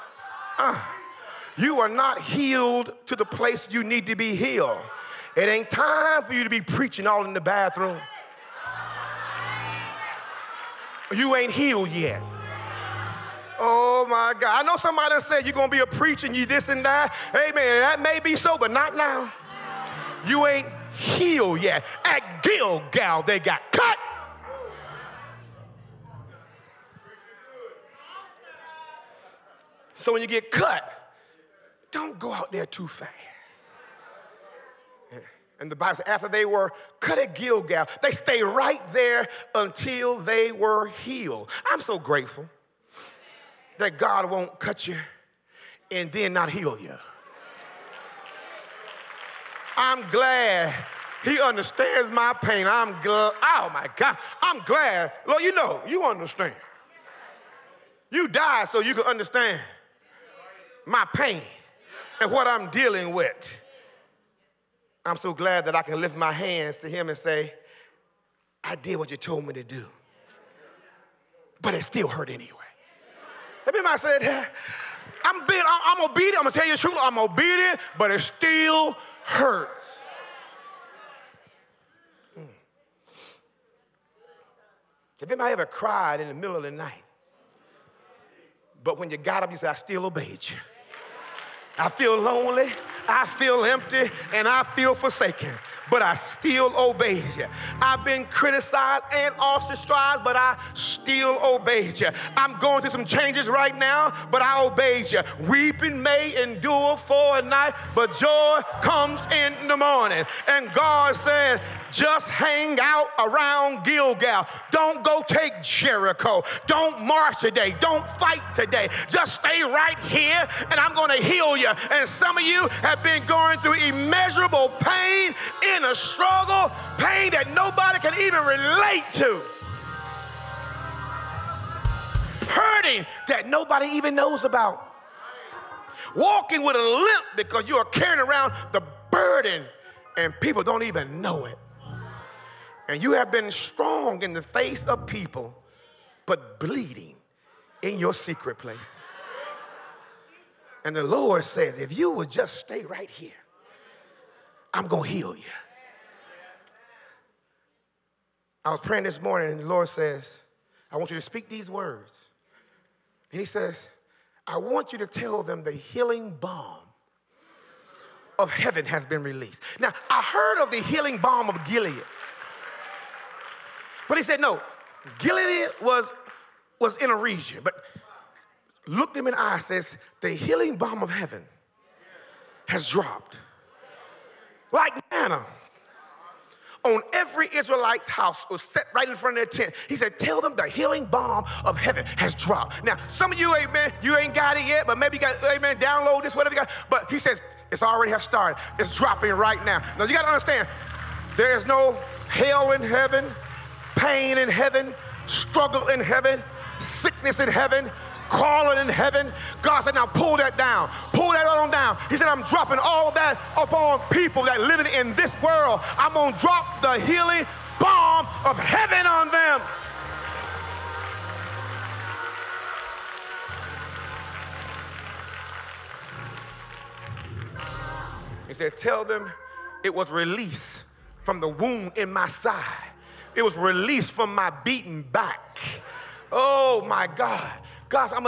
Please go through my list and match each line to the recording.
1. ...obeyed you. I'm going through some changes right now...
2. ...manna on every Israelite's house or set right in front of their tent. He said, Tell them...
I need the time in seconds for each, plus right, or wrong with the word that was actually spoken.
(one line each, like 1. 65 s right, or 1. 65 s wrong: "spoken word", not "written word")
1. 101 s right
2. 185 s right.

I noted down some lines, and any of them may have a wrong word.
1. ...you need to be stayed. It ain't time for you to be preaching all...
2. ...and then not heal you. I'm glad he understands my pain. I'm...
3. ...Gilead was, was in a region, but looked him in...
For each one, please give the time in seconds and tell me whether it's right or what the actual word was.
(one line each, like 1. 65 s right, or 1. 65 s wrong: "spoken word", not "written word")
1. 3 s wrong: "healed", not "stayed"
2. 45 s right
3. 175 s right.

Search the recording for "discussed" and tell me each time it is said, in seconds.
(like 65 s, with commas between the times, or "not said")
not said.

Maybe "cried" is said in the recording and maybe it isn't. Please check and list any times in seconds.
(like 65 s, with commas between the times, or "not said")
85 s.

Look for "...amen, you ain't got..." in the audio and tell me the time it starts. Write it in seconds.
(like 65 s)
193 s.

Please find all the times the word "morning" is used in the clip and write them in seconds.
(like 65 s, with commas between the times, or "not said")
109 s, 159 s.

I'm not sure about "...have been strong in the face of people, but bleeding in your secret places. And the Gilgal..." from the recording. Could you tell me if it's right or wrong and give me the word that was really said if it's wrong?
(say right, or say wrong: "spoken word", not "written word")
wrong: "Lord", not "Gilgal".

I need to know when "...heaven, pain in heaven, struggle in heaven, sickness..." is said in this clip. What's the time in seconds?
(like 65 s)
202 s.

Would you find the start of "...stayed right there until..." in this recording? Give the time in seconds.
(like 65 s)
38 s.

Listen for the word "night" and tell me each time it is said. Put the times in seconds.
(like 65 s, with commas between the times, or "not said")
86 s, 107 s.